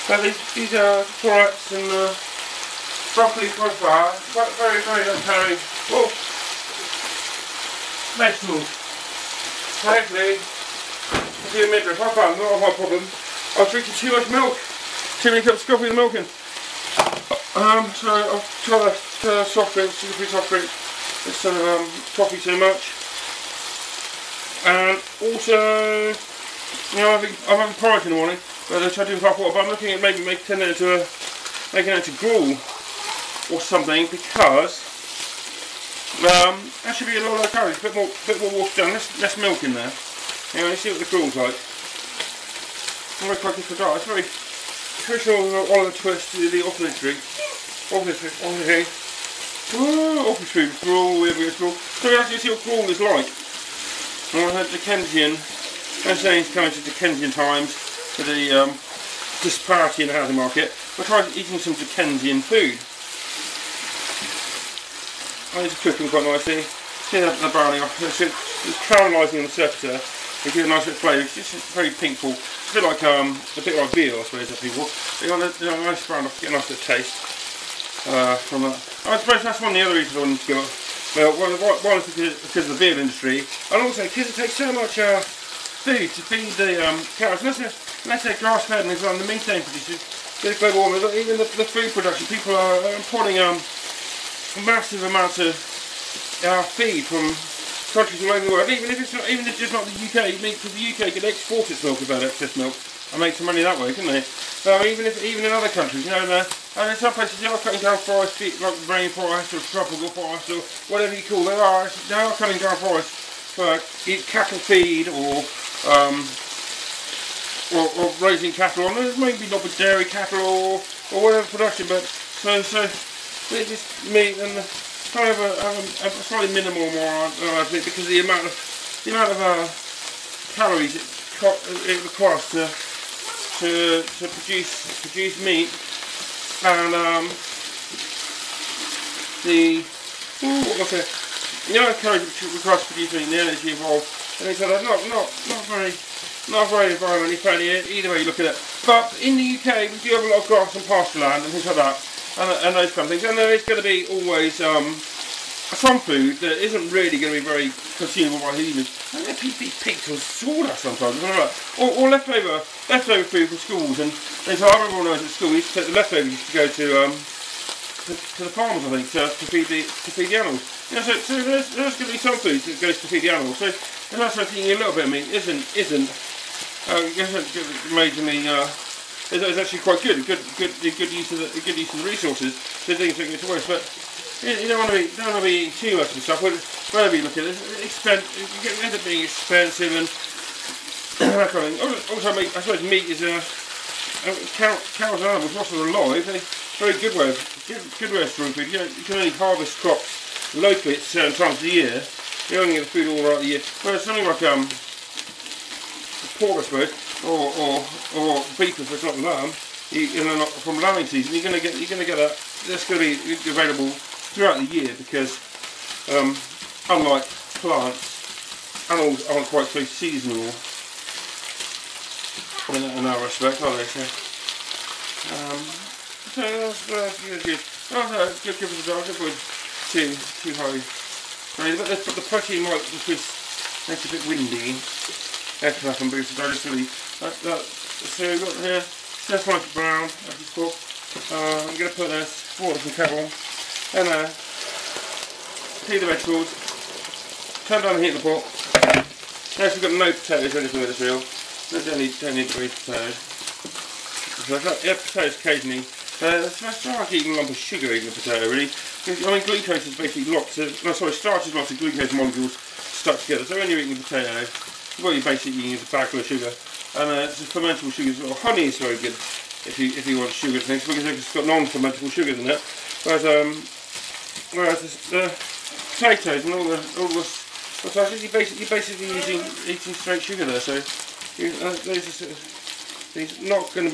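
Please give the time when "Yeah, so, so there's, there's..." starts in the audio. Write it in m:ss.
2:50.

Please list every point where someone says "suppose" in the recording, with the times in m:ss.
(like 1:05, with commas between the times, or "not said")
1:14, 1:19, 3:12, 3:26.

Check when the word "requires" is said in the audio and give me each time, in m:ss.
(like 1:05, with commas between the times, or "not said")
2:12, 2:22.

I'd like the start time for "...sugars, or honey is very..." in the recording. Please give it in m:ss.
4:27.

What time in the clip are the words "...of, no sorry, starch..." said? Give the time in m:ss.
4:20.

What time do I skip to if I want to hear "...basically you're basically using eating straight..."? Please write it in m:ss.
4:38.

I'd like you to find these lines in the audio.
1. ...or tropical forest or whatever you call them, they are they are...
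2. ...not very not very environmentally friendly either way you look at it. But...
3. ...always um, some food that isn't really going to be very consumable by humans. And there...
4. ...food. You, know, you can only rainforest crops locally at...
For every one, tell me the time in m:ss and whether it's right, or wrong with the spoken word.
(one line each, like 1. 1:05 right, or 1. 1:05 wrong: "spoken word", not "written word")
1. 1:49 right
2. 2:25 right
3. 2:34 right
4. 3:18 wrong: "harvest", not "rainforest".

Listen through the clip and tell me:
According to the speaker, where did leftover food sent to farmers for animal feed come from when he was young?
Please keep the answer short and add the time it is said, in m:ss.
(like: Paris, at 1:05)
schools, at 2:43.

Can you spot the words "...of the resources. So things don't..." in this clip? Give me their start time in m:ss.
3:01.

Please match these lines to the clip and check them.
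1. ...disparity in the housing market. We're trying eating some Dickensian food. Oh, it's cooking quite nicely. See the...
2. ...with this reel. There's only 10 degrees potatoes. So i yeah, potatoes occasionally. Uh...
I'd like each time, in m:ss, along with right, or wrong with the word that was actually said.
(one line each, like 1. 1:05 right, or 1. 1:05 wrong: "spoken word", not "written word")
1. 0:59 right
2. 4:10 right.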